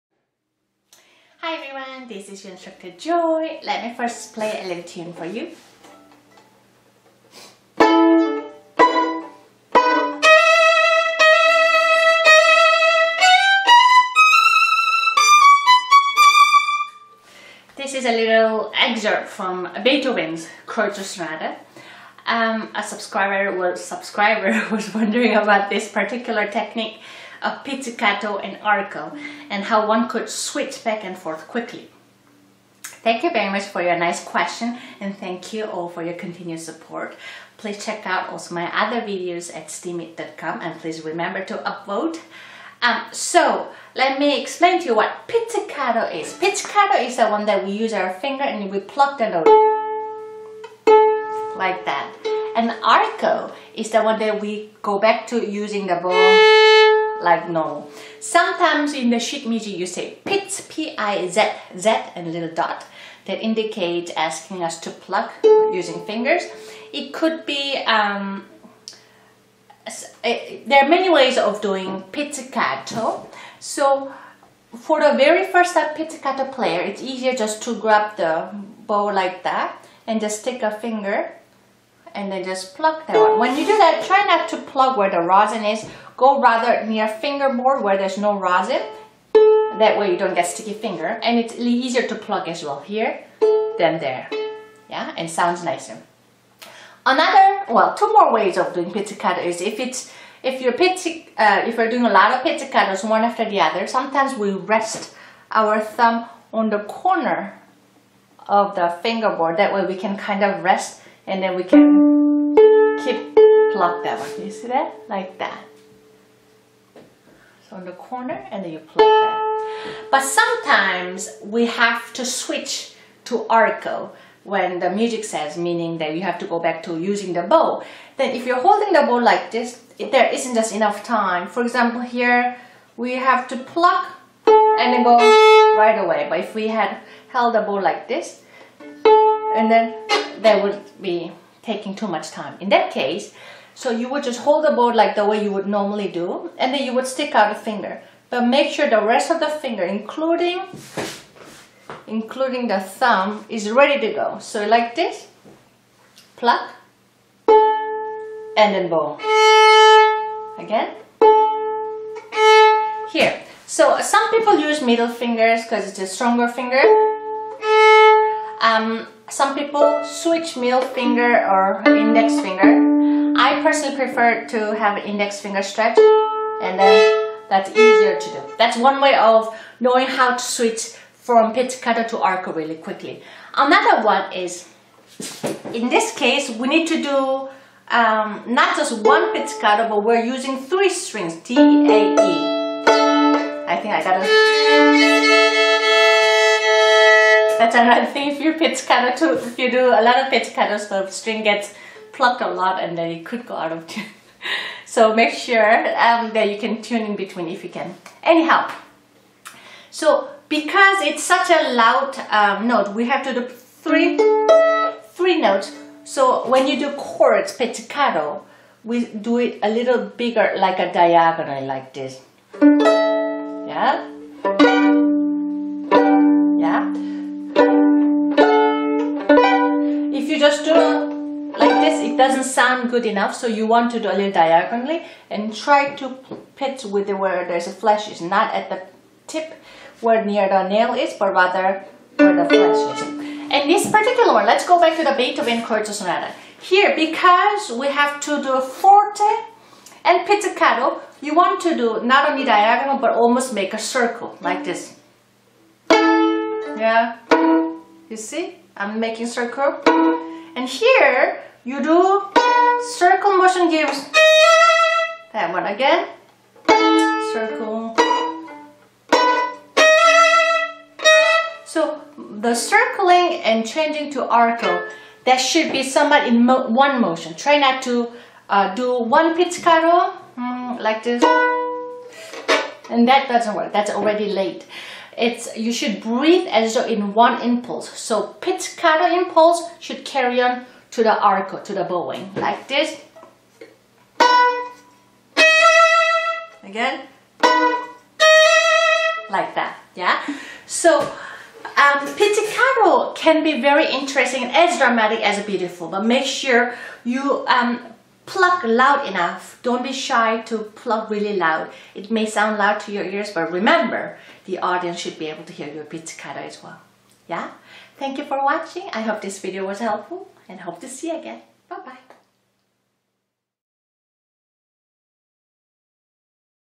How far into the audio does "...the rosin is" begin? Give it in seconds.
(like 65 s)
85 s.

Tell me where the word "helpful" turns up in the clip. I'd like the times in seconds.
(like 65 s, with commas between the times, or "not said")
319 s.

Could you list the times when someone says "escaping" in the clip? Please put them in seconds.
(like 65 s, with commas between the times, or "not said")
not said.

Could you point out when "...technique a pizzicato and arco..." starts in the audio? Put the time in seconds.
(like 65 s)
26 s.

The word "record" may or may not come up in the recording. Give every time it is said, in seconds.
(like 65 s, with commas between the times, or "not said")
not said.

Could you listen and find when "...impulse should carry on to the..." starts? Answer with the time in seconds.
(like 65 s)
289 s.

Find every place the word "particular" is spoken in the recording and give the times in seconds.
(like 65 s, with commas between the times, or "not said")
25 s, 243 s.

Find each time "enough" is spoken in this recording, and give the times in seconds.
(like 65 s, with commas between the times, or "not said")
130 s, 233 s, 309 s.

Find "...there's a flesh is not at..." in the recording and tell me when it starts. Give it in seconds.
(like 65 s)
237 s.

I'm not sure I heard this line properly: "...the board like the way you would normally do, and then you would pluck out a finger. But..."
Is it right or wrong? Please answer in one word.
wrong.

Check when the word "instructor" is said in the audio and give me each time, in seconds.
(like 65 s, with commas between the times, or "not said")
2 s.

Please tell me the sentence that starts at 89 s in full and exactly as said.
That way you don't get sticky finger.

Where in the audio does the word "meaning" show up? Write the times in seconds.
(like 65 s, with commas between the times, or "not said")
125 s.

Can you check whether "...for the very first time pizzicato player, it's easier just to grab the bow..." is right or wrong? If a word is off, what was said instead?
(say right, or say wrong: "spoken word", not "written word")
right.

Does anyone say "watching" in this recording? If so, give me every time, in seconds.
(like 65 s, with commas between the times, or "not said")
318 s.